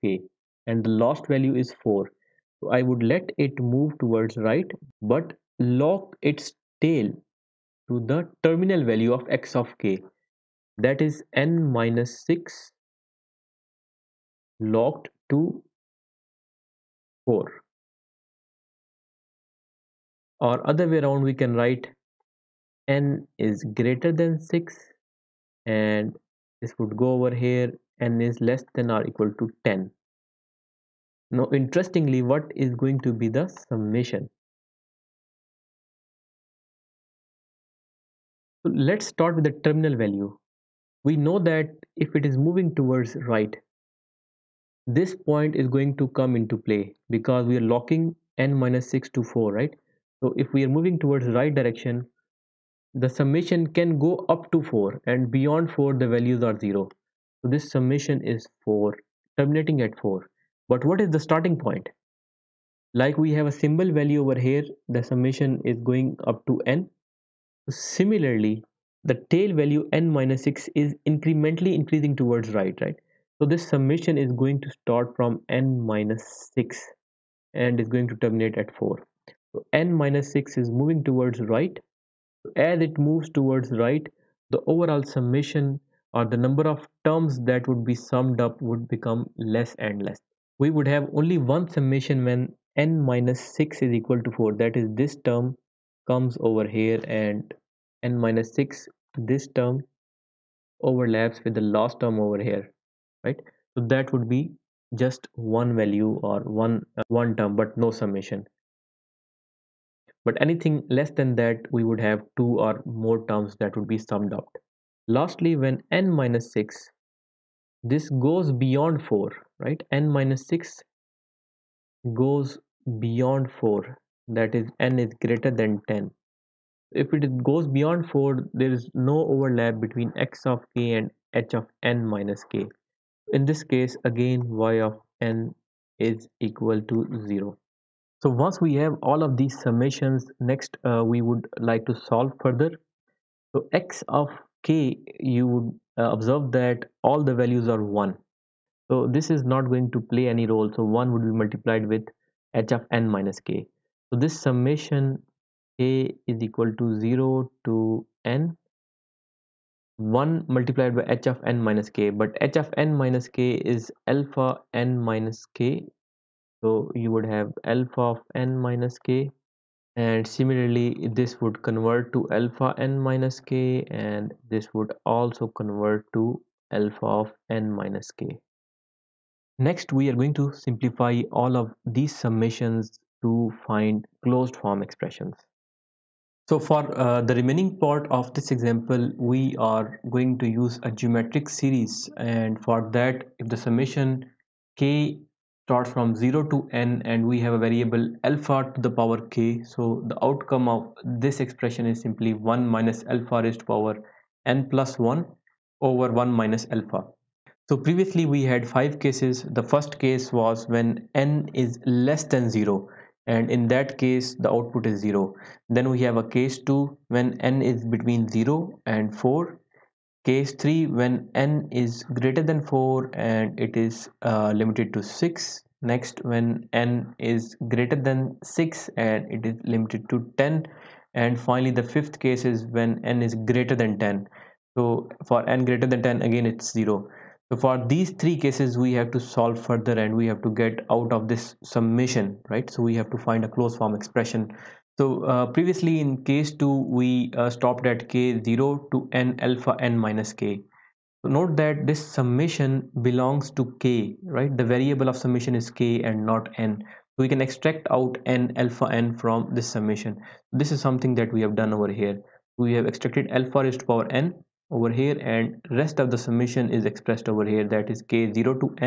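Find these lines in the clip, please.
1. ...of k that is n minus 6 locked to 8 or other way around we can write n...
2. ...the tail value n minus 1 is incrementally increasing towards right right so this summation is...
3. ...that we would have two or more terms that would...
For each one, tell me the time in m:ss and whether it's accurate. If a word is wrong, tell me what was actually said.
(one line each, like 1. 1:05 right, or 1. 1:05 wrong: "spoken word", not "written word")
1. 0:09 wrong: "4", not "8"
2. 1:09 wrong: "6", not "1"
3. 1:51 right.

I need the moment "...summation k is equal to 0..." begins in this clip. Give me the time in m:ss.
2:34.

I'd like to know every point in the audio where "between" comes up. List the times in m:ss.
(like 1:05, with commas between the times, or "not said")
2:09, 3:37.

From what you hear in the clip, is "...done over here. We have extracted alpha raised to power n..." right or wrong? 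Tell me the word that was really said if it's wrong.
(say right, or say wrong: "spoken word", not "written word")
right.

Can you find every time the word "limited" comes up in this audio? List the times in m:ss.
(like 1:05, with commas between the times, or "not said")
3:44, 3:49.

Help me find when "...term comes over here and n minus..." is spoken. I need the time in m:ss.
1:35.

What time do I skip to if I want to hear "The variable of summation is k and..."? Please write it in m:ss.
4:14.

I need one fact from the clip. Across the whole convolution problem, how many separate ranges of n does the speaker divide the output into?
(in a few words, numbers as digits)
5.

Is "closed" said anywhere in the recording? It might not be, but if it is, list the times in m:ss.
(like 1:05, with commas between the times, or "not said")
3:04, 4:03.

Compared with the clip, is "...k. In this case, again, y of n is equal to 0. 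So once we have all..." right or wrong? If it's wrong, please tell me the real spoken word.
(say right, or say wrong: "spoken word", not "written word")
right.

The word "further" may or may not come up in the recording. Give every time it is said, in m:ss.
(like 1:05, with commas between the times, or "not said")
2:22, 3:59.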